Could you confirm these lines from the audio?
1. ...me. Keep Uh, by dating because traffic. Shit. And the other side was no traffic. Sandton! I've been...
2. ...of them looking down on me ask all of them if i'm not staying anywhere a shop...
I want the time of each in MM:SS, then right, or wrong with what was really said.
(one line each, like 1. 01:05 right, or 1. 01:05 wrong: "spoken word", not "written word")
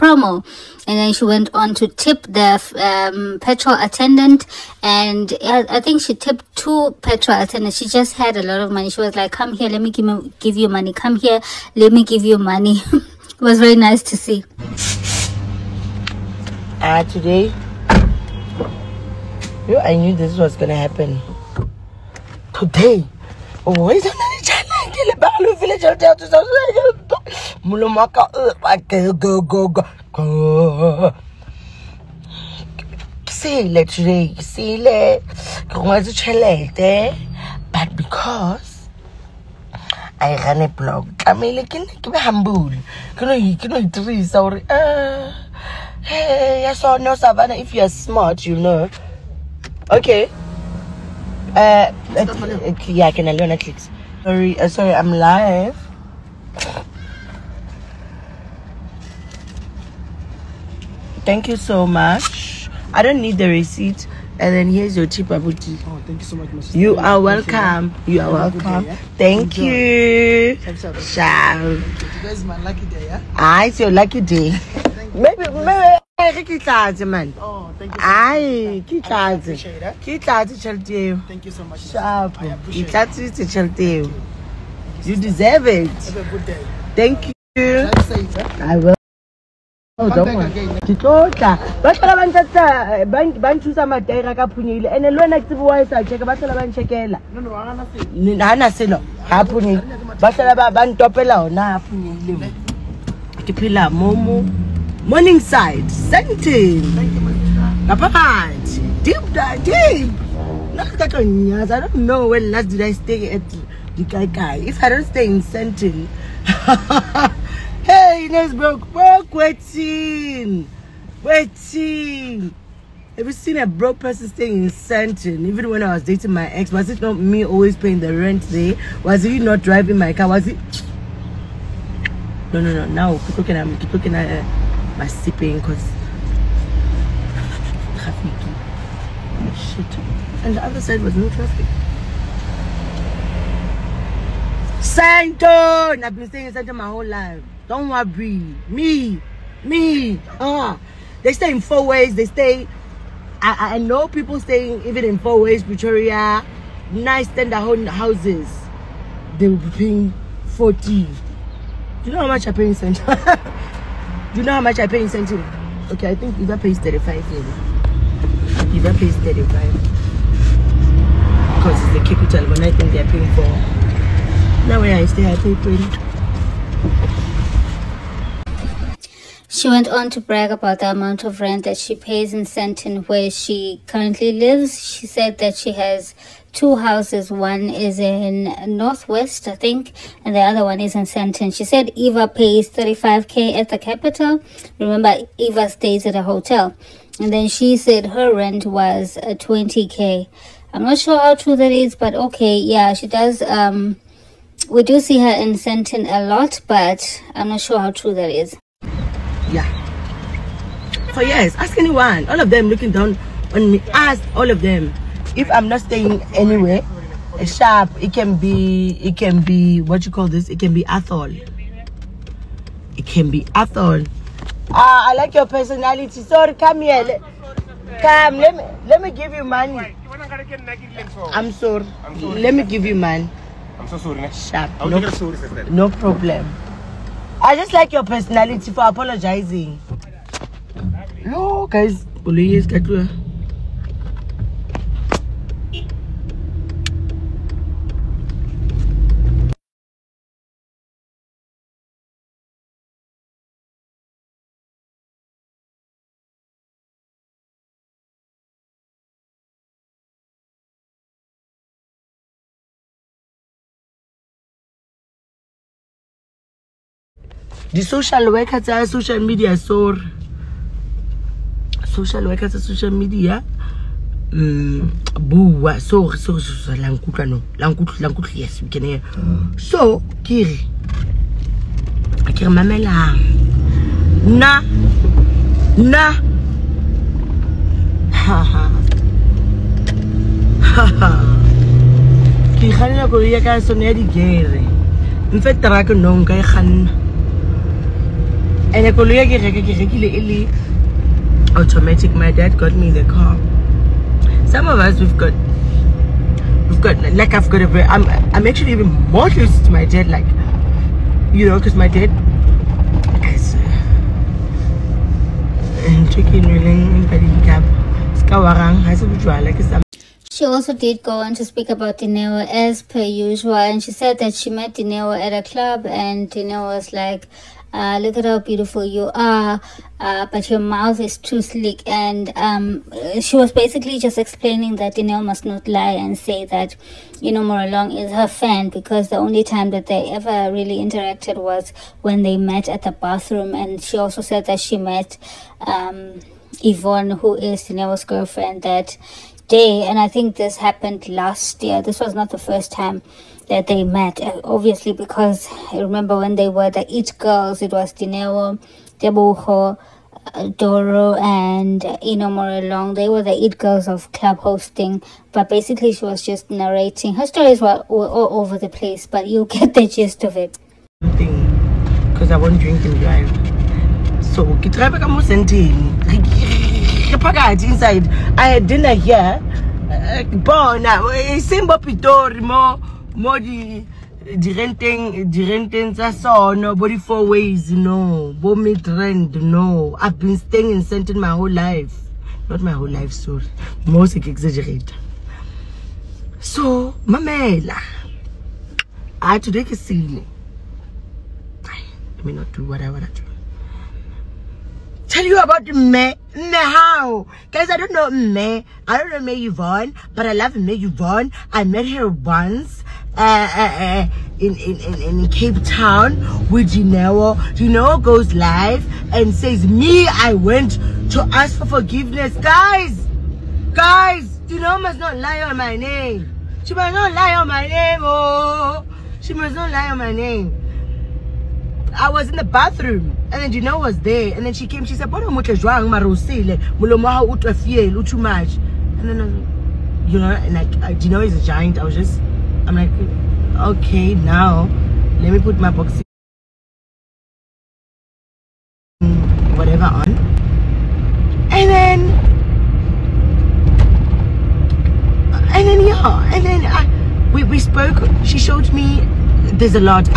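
1. 02:13 wrong: "sleeping", not "dating"
2. 03:32 right.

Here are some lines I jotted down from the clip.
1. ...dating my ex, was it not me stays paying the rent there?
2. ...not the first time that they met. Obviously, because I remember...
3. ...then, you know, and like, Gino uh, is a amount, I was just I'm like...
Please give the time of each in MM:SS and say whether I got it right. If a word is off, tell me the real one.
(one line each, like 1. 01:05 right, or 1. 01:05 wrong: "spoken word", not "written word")
1. 02:06 wrong: "always", not "stays"
2. 05:52 right
3. 07:19 wrong: "giant", not "amount".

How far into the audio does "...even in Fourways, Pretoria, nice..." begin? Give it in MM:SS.
02:34.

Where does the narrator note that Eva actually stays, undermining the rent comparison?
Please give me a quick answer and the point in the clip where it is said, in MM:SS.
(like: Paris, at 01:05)
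A hotel, at 03:16.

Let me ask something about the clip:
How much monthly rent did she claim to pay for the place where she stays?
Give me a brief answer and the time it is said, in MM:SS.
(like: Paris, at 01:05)
20, at 02:55.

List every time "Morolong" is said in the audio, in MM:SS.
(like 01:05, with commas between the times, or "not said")
05:37, 06:02.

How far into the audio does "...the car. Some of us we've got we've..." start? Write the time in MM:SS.
05:02.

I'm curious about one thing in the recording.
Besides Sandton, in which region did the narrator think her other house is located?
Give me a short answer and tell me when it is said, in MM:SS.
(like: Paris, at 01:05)
Northwest, at 03:08.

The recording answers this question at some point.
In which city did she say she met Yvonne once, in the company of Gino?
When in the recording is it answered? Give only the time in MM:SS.
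06:55.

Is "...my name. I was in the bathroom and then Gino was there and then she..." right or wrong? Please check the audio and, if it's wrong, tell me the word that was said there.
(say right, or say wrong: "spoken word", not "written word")
right.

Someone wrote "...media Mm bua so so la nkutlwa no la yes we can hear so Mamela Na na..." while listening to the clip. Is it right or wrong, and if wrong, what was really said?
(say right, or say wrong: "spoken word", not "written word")
right.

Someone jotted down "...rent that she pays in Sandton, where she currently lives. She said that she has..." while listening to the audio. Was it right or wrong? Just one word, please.
right.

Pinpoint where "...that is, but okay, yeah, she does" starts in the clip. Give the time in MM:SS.
03:21.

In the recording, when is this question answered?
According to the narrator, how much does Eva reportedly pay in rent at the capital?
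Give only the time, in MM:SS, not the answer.
03:11.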